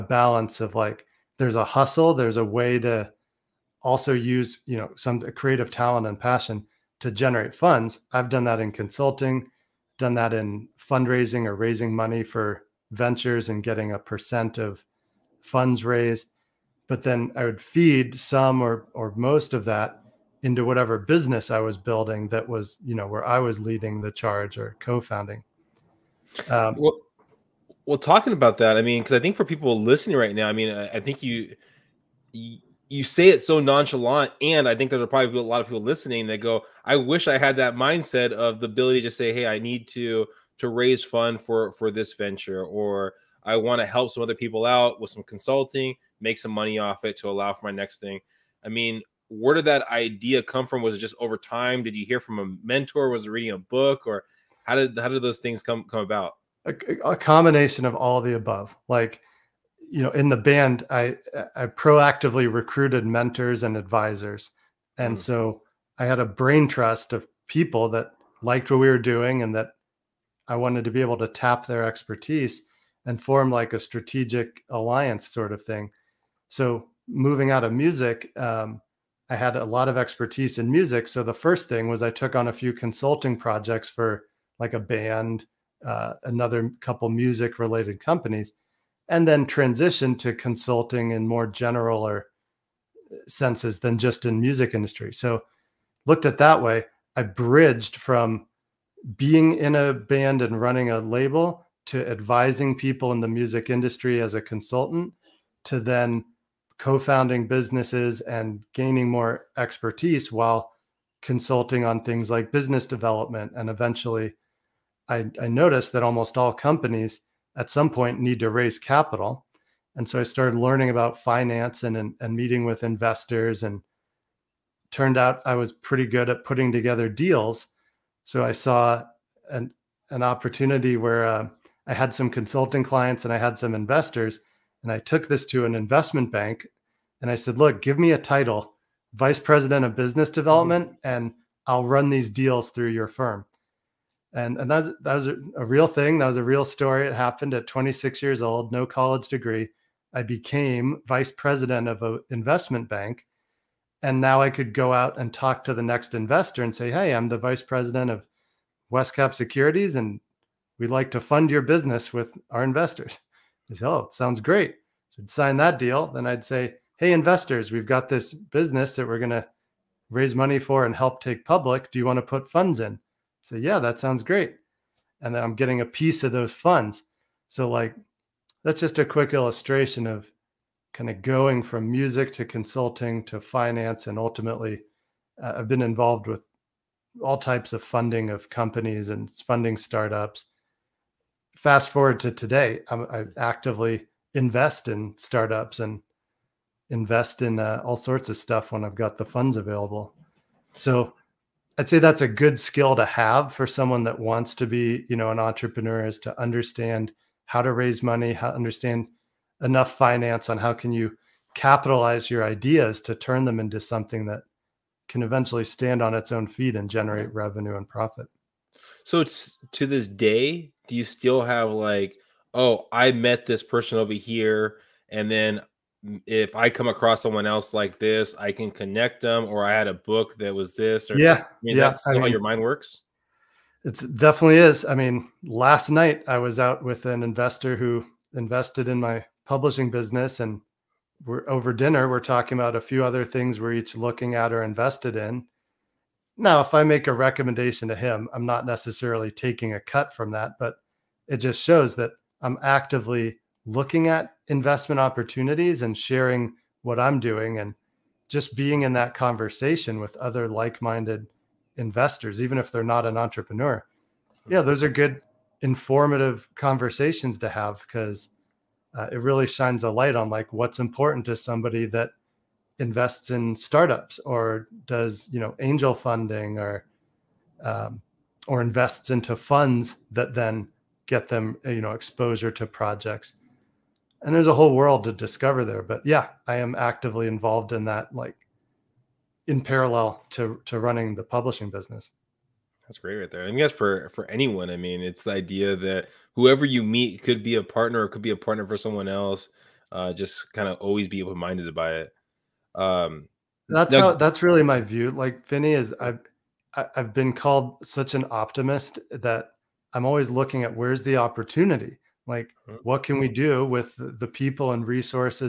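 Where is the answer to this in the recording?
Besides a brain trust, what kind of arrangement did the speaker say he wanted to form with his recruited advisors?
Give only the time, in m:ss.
1:13.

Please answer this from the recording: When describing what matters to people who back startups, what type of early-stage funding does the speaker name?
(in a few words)
angel funding.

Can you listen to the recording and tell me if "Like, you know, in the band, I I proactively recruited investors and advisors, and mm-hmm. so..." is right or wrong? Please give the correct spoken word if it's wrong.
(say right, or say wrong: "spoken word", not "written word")
wrong: "mentors", not "investors".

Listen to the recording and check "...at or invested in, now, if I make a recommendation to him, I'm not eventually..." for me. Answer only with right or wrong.
wrong.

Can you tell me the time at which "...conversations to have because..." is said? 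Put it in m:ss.
4:26.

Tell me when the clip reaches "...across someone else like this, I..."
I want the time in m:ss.
3:46.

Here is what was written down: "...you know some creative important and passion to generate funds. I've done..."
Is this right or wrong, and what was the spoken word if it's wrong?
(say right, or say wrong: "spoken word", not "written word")
wrong: "talent", not "important".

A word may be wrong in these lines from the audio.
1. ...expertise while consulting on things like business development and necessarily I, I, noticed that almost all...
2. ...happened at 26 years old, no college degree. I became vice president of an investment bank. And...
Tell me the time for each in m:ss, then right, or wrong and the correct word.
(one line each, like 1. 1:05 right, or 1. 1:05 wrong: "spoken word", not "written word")
1. 1:49 wrong: "eventually", not "necessarily"
2. 2:27 right.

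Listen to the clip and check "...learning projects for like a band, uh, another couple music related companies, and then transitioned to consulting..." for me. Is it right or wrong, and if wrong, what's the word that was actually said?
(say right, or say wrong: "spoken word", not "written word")
wrong: "consulting", not "learning".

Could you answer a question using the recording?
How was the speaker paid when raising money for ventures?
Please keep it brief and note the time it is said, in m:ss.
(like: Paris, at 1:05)
a percent of funds raised, at 0:13.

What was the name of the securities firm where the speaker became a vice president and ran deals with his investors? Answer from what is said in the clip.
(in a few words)
Westcap Securities.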